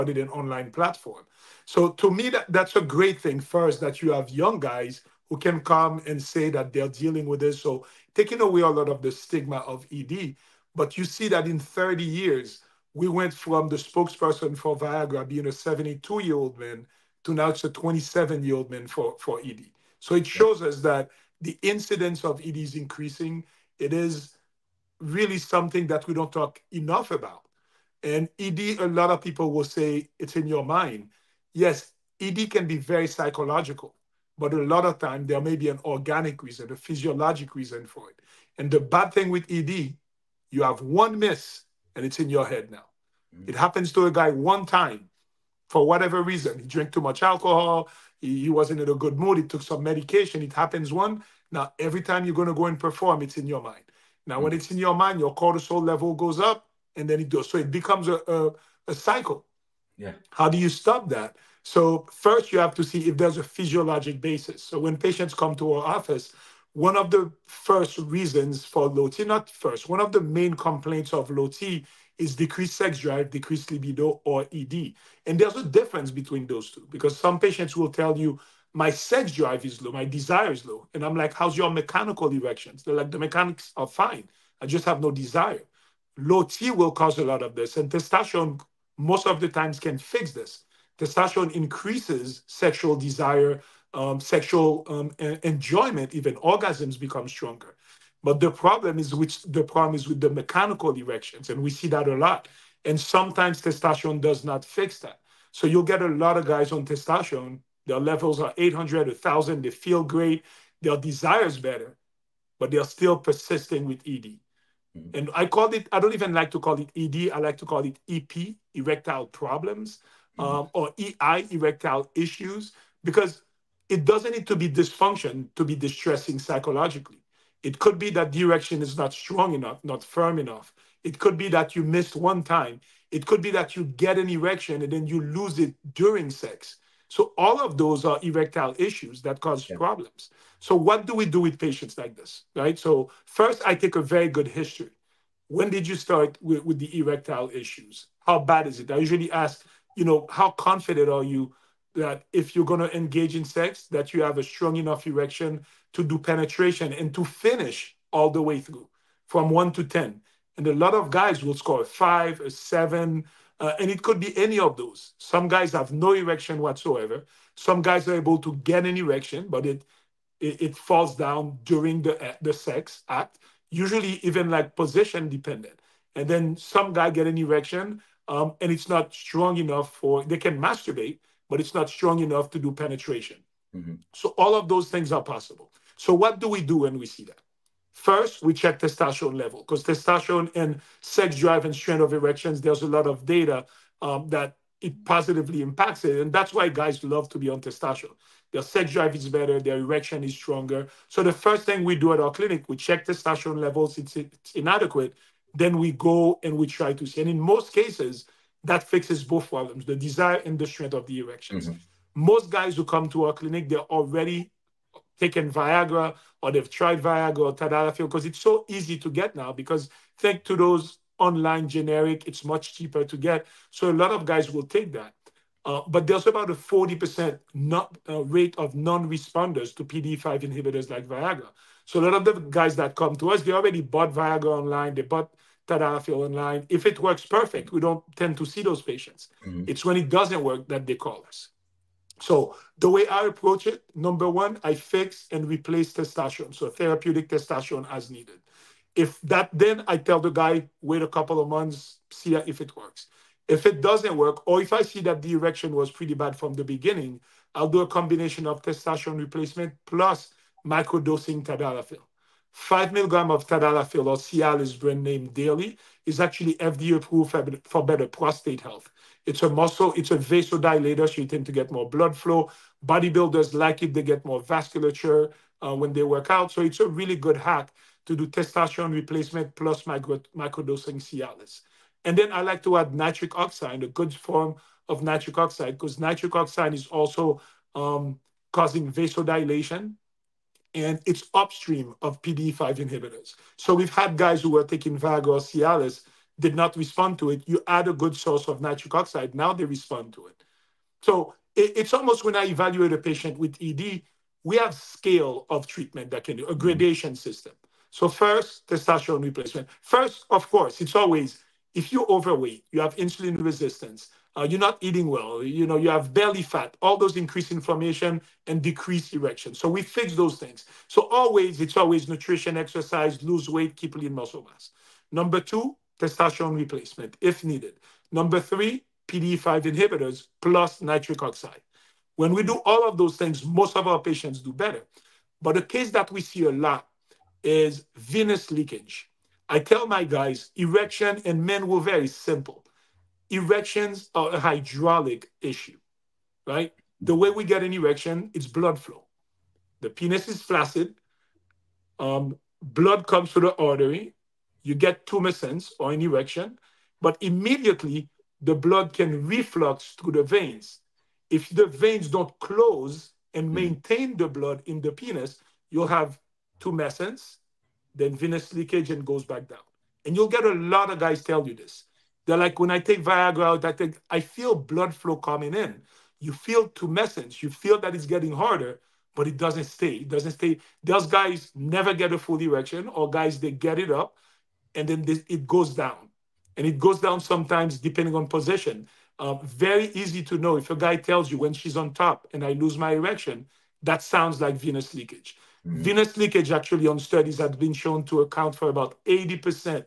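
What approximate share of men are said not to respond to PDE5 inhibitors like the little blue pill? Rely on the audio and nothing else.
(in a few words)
40%.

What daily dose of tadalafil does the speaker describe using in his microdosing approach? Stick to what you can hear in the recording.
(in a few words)
5 milligrams.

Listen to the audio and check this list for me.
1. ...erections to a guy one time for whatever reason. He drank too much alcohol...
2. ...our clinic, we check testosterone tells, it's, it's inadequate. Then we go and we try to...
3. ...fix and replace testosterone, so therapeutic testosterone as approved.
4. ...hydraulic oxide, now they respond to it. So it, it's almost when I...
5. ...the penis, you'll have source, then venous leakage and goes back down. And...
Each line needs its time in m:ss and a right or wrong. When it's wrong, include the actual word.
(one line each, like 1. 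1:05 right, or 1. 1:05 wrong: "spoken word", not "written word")
1. 0:43 wrong: "happens", not "erections"
2. 3:22 wrong: "levels", not "tells"
3. 4:04 wrong: "needed", not "approved"
4. 4:58 wrong: "nitric", not "hydraulic"
5. 6:04 wrong: "tumescence", not "source".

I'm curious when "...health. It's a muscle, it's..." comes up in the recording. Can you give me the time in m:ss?
4:28.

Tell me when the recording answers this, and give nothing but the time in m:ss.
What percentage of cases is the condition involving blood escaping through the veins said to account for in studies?
6:39.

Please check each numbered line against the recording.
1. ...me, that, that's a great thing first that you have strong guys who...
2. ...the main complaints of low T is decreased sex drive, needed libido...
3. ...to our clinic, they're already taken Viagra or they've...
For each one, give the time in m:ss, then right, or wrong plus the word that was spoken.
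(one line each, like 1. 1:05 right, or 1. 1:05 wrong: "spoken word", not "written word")
1. 0:02 wrong: "young", not "strong"
2. 1:10 wrong: "decreased", not "needed"
3. 3:33 right.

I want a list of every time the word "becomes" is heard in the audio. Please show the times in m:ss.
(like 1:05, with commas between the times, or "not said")
0:57, 1:36.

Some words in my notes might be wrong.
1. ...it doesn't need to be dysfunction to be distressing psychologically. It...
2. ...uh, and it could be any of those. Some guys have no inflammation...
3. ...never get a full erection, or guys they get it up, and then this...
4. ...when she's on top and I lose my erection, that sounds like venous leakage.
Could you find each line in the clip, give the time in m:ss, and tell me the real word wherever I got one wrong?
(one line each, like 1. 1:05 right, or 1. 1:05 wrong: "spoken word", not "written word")
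1. 2:03 right
2. 2:43 wrong: "erection", not "inflammation"
3. 6:21 right
4. 6:31 right.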